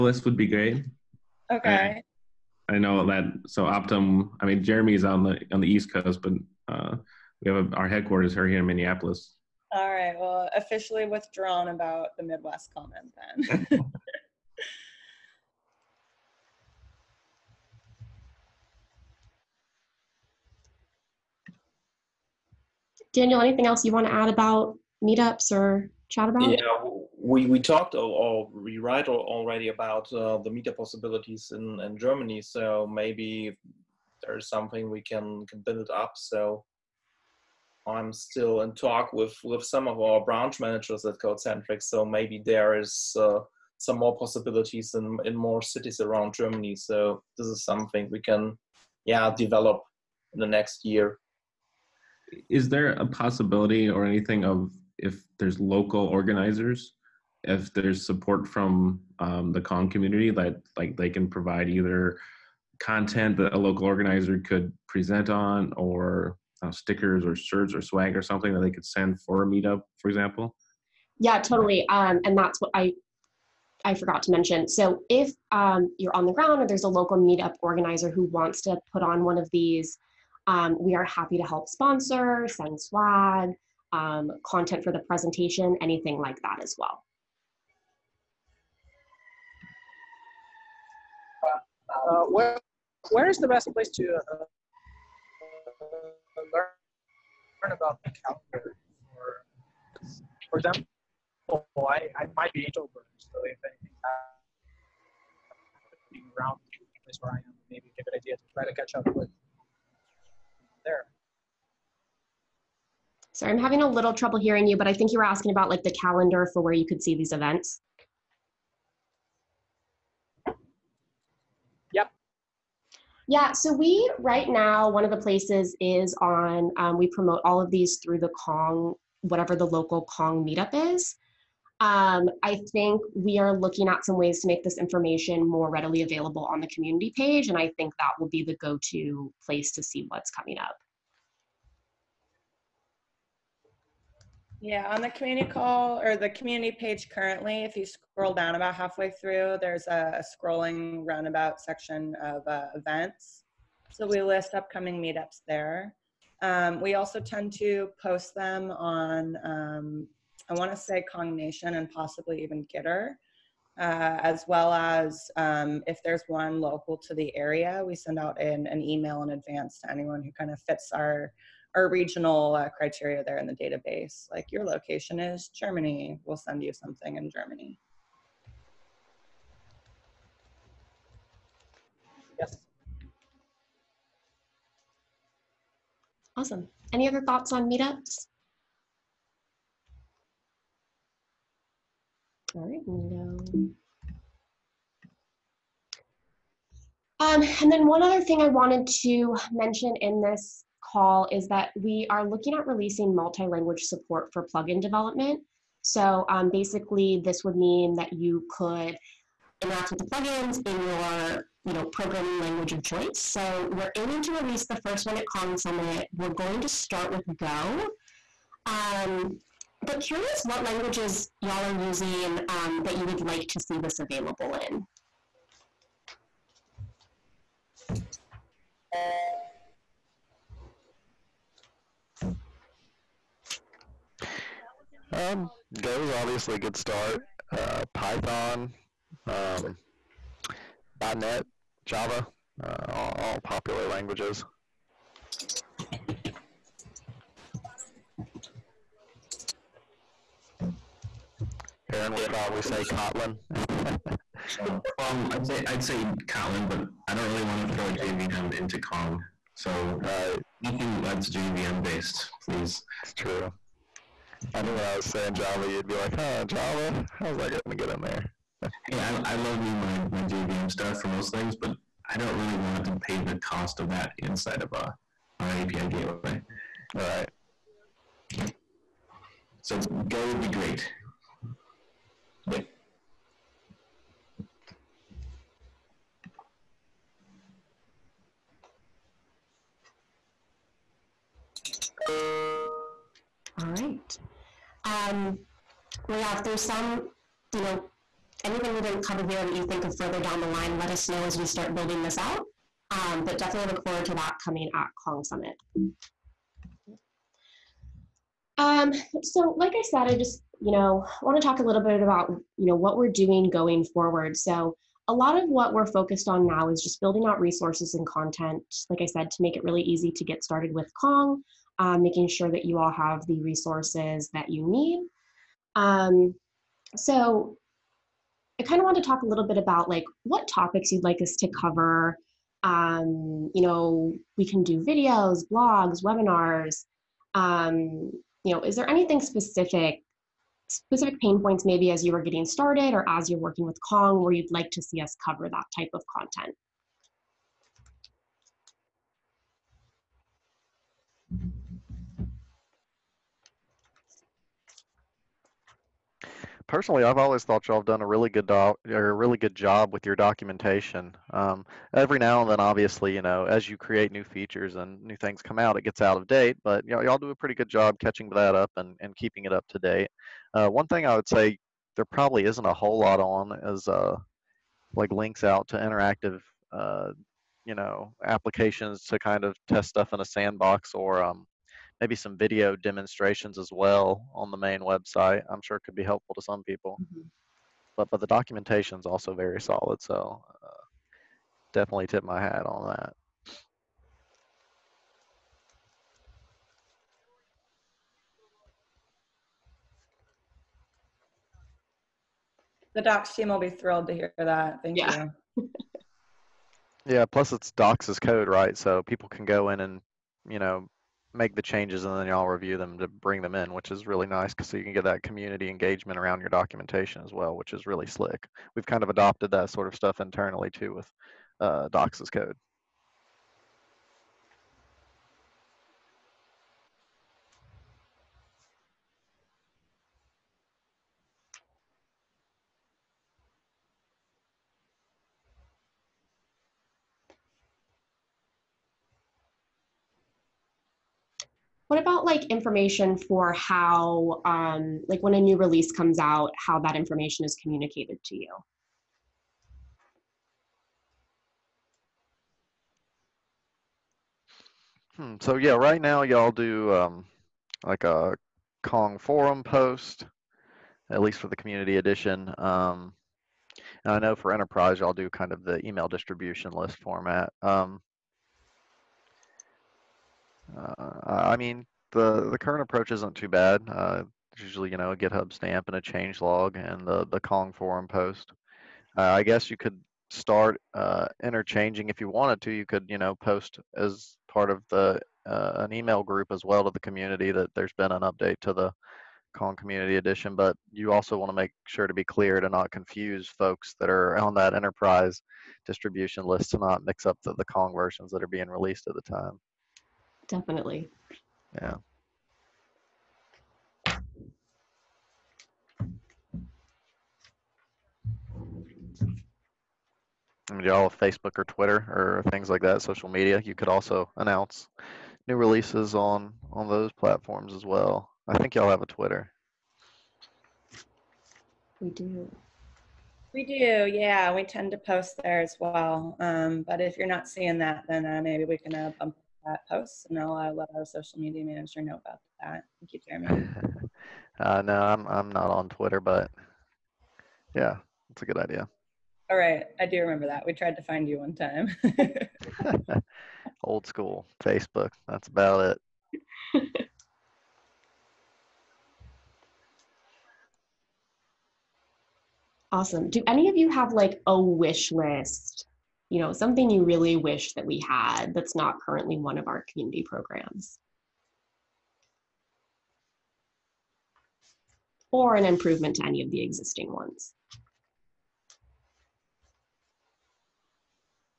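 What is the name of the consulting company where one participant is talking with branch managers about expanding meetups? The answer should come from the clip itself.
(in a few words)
Codecentric.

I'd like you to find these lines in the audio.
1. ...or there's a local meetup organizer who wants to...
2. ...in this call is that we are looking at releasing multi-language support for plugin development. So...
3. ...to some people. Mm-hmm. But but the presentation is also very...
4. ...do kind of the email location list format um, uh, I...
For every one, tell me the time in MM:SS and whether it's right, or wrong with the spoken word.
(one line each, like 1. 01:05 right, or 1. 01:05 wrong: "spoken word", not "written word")
1. 01:16 right
2. 03:20 right
3. 06:26 wrong: "documentation", not "presentation"
4. 07:45 wrong: "distribution", not "location".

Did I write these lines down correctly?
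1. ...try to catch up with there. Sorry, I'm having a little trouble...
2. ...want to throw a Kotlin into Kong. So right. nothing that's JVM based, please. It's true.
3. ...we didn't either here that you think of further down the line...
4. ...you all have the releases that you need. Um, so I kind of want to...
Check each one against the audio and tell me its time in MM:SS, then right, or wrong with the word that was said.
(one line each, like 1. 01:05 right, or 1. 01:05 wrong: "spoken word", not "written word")
1. 01:48 right
2. 04:17 wrong: "JVM", not "Kotlin"
3. 04:58 wrong: "cover", not "either"
4. 05:22 wrong: "resources", not "releases".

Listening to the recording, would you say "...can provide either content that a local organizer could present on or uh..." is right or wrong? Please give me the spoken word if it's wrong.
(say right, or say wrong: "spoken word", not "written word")
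right.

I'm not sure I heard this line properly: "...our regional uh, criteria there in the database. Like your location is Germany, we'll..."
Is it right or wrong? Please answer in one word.
right.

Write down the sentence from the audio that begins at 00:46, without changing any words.
So this is something we can, yeah, develop in the next year.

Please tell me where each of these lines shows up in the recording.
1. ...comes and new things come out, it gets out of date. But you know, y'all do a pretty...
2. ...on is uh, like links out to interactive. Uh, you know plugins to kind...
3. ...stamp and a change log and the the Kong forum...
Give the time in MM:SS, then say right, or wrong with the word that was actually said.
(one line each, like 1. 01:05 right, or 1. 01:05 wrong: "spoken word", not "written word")
1. 06:04 wrong: "features", not "comes"
2. 06:13 wrong: "applications", not "plugins"
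3. 07:55 right.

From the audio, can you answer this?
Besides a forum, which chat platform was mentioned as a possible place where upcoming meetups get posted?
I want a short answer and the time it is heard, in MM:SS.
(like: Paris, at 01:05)
Gitter, at 02:42.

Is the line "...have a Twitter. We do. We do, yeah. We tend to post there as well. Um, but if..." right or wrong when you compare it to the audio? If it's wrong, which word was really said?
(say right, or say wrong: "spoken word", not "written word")
right.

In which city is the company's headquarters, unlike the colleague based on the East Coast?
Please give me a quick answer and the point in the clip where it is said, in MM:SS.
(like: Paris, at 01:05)
Minneapolis, at 00:08.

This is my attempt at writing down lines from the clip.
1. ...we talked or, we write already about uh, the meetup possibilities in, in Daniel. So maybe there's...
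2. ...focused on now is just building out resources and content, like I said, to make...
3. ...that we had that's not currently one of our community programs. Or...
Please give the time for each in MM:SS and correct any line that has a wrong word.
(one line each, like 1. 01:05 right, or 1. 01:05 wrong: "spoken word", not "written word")
1. 00:27 wrong: "Germany", not "Daniel"
2. 05:15 right
3. 09:17 right.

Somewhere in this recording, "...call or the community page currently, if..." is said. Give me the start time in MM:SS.
02:25.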